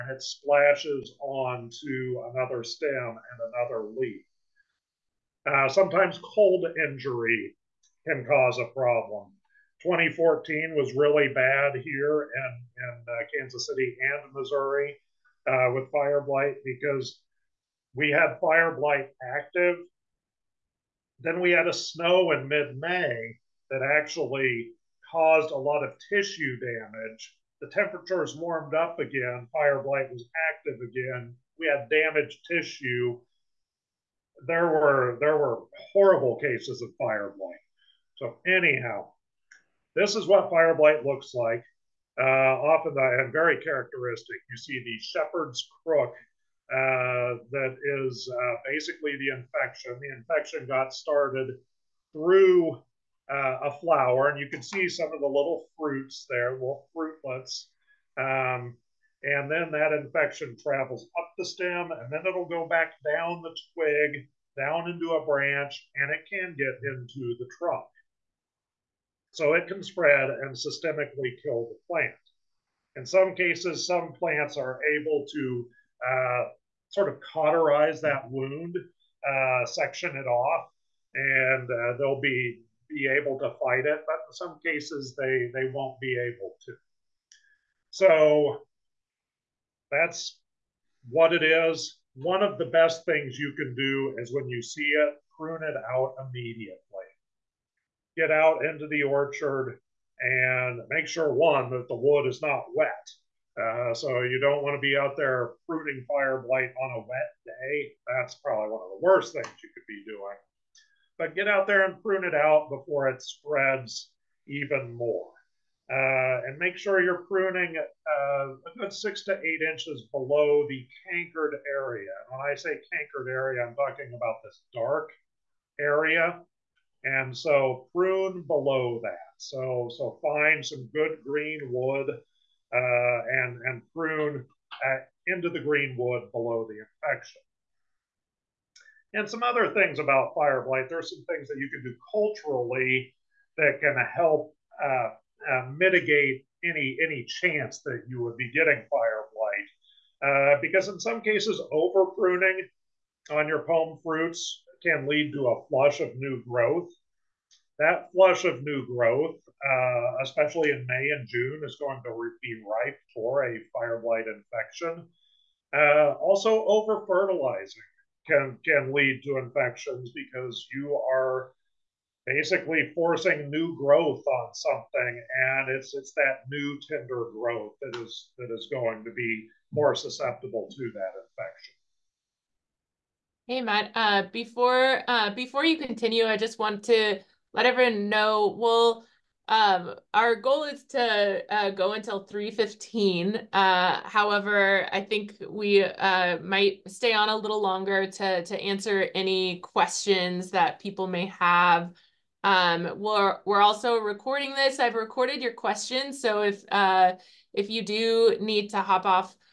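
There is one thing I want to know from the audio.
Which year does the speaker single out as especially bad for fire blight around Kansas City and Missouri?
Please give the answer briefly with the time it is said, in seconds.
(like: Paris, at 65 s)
2014, at 9 s.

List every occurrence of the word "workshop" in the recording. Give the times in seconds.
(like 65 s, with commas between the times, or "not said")
not said.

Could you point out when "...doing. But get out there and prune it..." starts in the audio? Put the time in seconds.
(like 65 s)
110 s.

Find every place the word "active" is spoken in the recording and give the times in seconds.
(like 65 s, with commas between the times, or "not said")
19 s, 30 s.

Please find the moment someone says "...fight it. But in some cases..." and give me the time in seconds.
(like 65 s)
83 s.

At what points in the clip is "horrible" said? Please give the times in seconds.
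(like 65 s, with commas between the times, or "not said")
35 s.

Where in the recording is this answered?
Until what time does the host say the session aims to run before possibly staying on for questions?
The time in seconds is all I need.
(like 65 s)
192 s.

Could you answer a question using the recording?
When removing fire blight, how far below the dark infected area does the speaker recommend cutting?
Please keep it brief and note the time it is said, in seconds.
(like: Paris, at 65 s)
6 to 8 inches, at 118 s.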